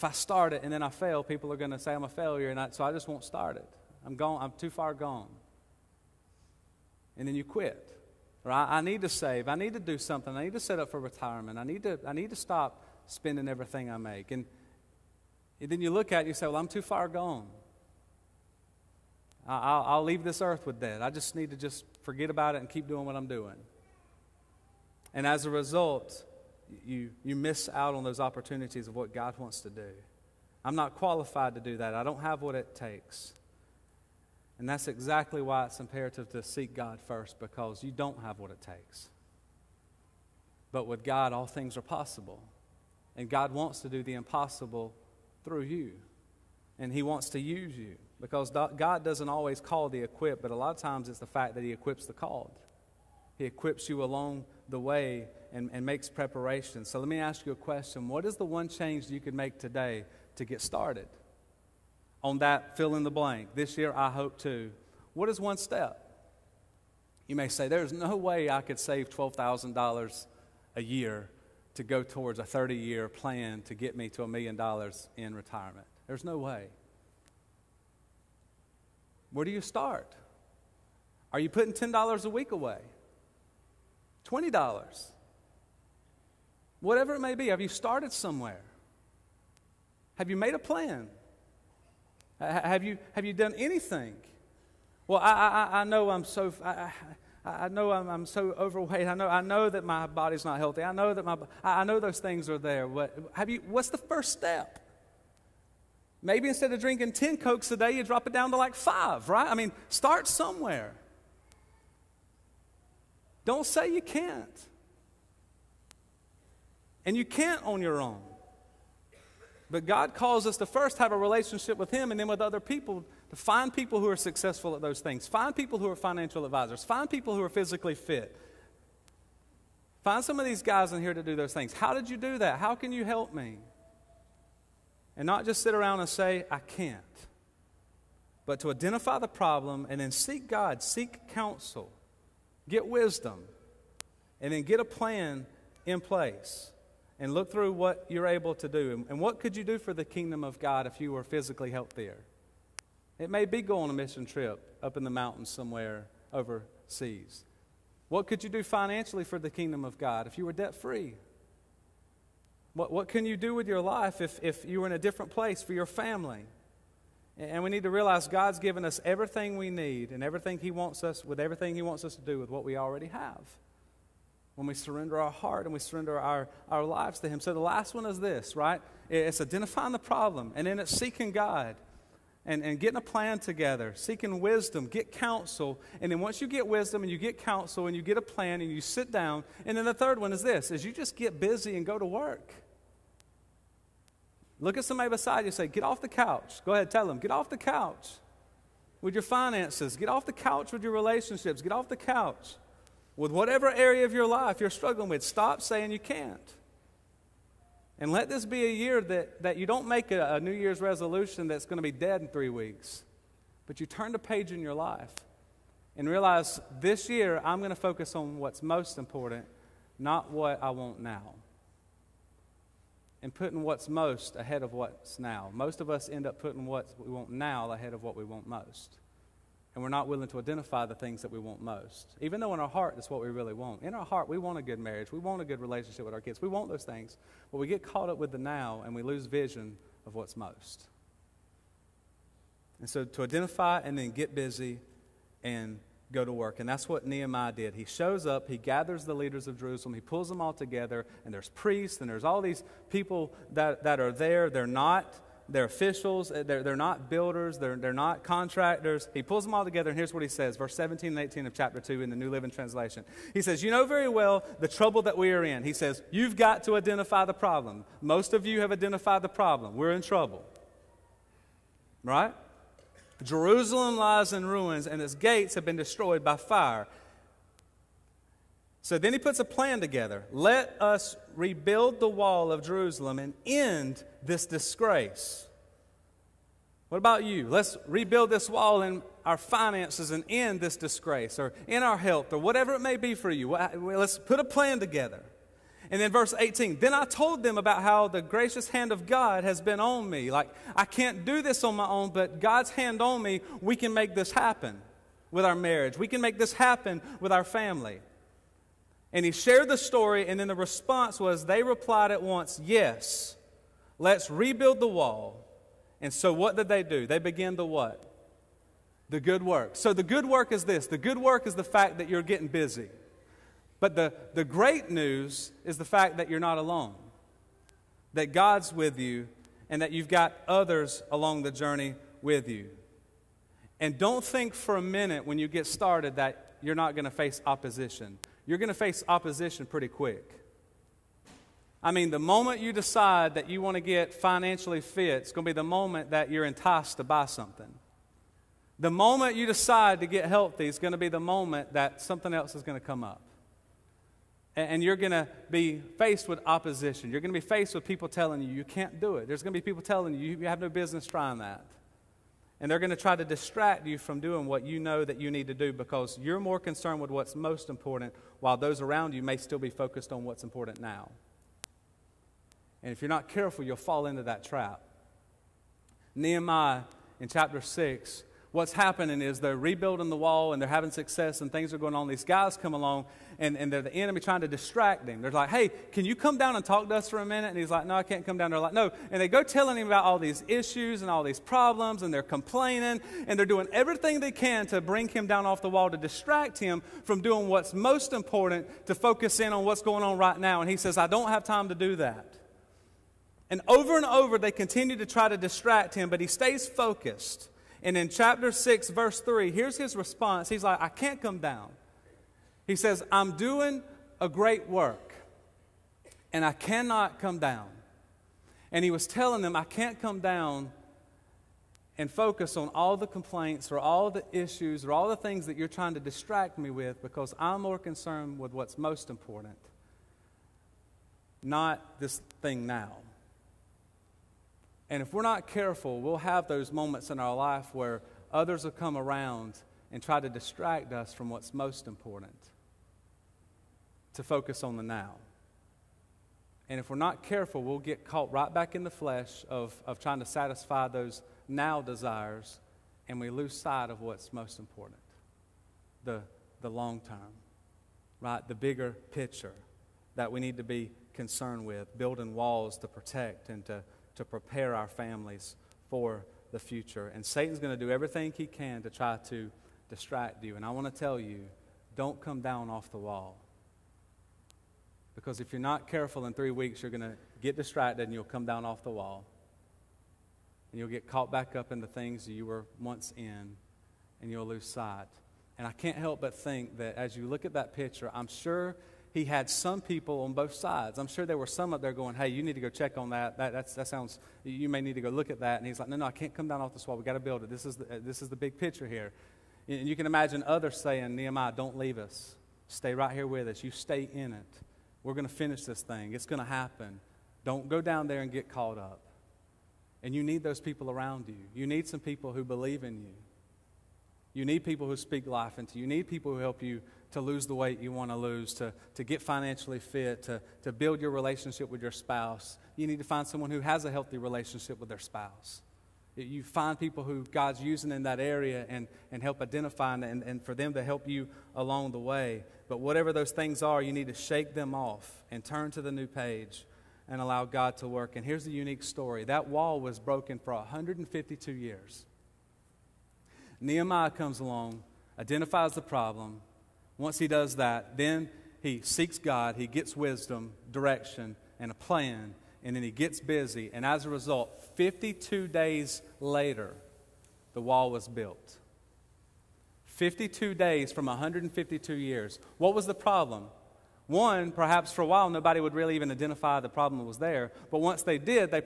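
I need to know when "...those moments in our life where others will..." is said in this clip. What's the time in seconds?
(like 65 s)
436 s.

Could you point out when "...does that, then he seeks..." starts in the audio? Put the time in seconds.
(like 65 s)
547 s.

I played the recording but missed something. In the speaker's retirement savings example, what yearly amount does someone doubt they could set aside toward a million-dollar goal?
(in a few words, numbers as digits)
$12,000.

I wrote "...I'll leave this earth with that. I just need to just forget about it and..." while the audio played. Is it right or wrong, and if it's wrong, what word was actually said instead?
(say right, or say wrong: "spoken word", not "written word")
right.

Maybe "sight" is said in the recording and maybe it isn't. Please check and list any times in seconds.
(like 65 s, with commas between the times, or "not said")
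453 s, 484 s.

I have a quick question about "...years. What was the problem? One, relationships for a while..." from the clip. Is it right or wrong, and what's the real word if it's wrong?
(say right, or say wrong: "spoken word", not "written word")
wrong: "perhaps", not "relationships".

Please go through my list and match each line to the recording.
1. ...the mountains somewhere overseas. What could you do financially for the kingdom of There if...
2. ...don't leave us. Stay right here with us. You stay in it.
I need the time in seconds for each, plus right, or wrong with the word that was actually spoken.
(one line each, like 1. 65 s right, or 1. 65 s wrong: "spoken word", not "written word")
1. 155 s wrong: "God", not "There"
2. 501 s right.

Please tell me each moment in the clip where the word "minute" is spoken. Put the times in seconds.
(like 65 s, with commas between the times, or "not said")
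334 s, 387 s.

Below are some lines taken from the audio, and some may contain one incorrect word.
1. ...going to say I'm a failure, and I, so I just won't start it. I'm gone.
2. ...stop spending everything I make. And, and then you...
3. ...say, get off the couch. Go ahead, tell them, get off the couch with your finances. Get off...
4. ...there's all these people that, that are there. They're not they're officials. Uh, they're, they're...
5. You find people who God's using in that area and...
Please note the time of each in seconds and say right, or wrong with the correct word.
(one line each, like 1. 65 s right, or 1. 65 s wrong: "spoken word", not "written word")
1. 1 s right
2. 12 s right
3. 195 s right
4. 252 s right
5. 526 s right.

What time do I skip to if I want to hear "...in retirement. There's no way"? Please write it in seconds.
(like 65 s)
75 s.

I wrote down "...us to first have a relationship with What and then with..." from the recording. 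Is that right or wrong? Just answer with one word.
wrong.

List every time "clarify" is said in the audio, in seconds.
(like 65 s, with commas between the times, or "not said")
not said.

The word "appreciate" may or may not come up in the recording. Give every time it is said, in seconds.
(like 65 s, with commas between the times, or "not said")
not said.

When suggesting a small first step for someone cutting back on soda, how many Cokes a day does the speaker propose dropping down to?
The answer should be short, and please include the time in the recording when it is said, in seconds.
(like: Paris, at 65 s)
5, at 108 s.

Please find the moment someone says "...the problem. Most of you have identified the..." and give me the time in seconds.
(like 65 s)
267 s.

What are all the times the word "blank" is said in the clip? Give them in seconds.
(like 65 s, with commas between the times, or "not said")
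63 s.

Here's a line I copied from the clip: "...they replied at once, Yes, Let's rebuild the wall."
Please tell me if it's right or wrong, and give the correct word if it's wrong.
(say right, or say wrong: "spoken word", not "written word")
right.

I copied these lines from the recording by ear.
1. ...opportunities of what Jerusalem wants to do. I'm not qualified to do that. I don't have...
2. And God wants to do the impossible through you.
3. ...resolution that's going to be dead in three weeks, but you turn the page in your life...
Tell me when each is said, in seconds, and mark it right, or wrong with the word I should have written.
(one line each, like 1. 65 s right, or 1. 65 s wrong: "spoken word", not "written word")
1. 28 s wrong: "God", not "Jerusalem"
2. 43 s right
3. 210 s right.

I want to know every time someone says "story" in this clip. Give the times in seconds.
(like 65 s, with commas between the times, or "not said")
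309 s, 538 s.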